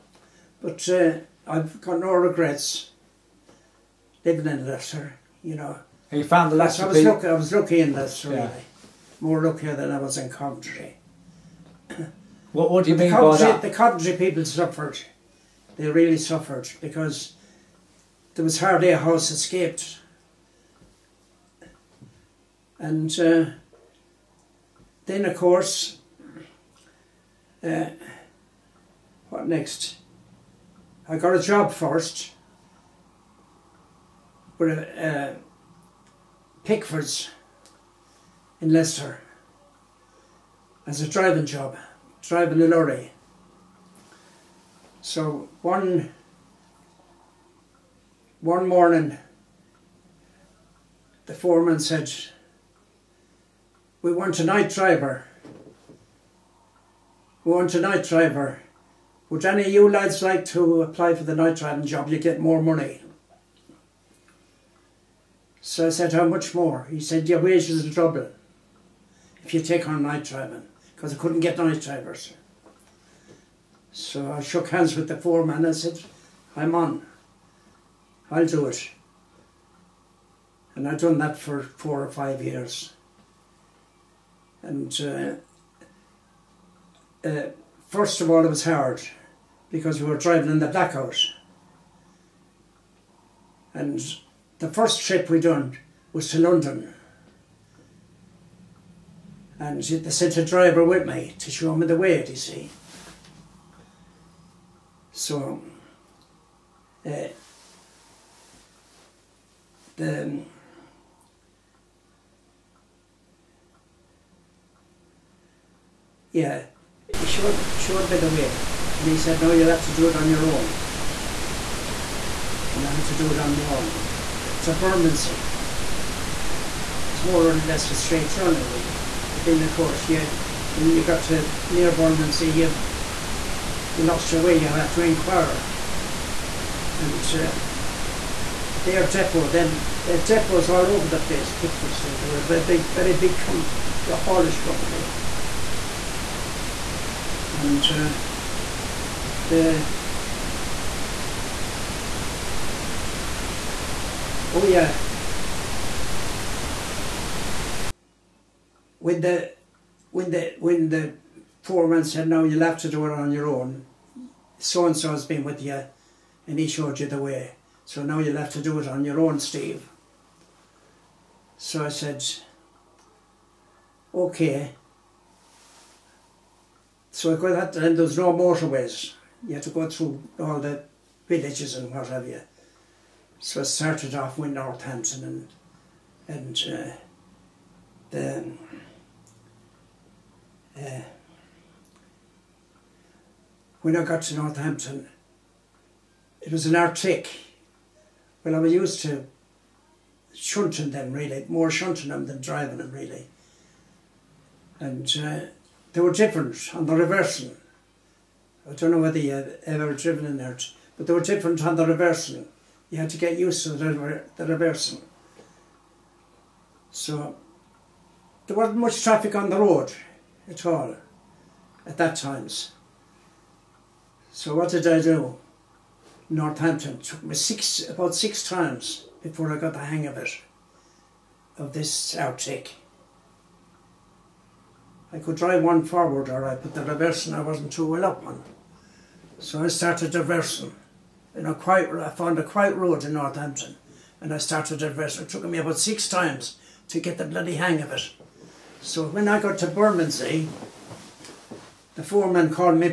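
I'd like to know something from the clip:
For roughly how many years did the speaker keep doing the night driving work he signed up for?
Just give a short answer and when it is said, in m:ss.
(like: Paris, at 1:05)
4 or 5 years, at 1:21.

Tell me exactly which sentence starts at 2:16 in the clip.
And uh, their depot, then their depots all over the place, Pickford's, they were a very big, very big com haulage company.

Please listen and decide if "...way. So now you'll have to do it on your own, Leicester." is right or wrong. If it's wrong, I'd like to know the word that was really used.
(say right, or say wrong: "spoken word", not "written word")
wrong: "Steve", not "Leicester".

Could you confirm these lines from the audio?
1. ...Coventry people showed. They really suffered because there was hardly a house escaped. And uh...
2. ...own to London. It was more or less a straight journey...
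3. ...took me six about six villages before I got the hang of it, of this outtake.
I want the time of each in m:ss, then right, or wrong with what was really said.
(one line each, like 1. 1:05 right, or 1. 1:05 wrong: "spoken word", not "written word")
1. 0:13 wrong: "suffered", not "showed"
2. 2:03 wrong: "Bermondsey", not "London"
3. 3:46 wrong: "times", not "villages".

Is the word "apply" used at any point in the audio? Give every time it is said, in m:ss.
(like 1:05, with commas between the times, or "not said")
1:00.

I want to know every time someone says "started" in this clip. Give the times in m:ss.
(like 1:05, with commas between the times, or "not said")
3:03, 3:59, 4:04.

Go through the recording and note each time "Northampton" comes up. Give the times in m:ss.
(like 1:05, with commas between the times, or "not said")
3:04, 3:14, 3:46, 4:03.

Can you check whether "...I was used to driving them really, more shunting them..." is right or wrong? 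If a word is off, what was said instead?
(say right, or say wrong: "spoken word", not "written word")
wrong: "shunting", not "driving".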